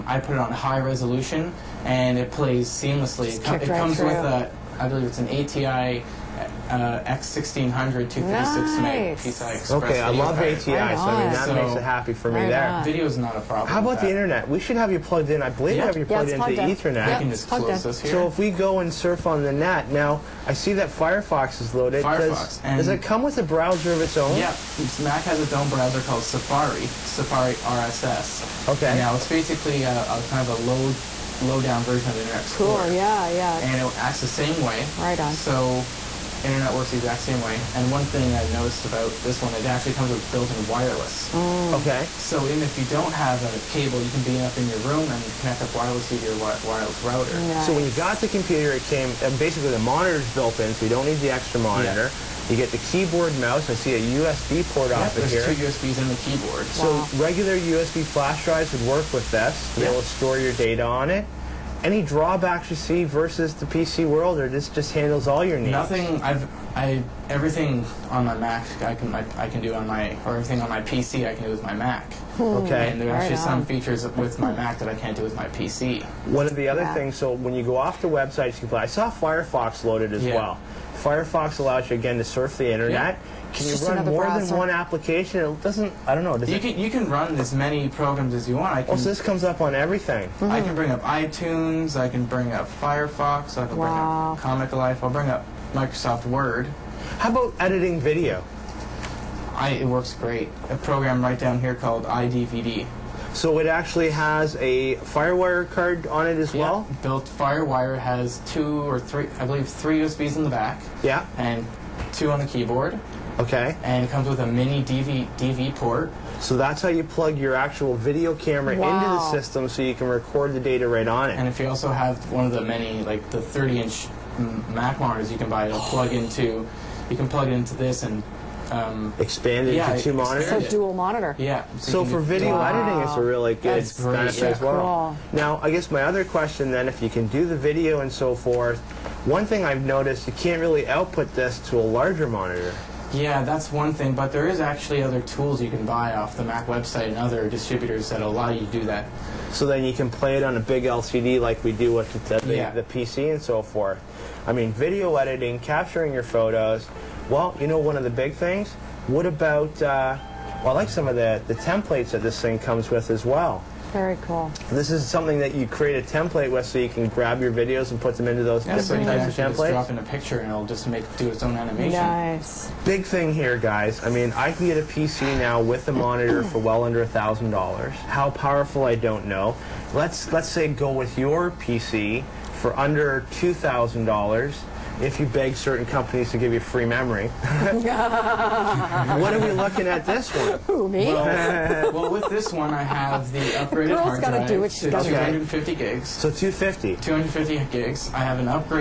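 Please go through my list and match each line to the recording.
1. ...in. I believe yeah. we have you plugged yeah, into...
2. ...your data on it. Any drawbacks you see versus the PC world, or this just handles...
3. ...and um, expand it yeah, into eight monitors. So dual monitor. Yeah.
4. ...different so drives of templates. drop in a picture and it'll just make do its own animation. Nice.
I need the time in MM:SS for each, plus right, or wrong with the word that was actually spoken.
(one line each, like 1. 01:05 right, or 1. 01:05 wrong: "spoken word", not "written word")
1. 00:15 right
2. 01:00 right
3. 02:08 wrong: "two", not "eight"
4. 02:48 wrong: "types", not "drives".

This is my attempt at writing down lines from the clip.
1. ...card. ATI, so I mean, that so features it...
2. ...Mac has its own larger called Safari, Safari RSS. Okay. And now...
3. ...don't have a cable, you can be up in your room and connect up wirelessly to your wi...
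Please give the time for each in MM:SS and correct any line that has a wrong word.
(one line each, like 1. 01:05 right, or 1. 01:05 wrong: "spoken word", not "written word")
1. 00:10 wrong: "makes", not "features"
2. 00:24 wrong: "browser", not "larger"
3. 00:42 right.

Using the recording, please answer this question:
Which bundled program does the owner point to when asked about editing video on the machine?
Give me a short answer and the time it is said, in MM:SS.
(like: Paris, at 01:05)
iDVD, at 01:42.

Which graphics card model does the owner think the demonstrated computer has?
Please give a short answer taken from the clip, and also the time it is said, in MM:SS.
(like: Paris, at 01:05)
ATI X1600, at 00:05.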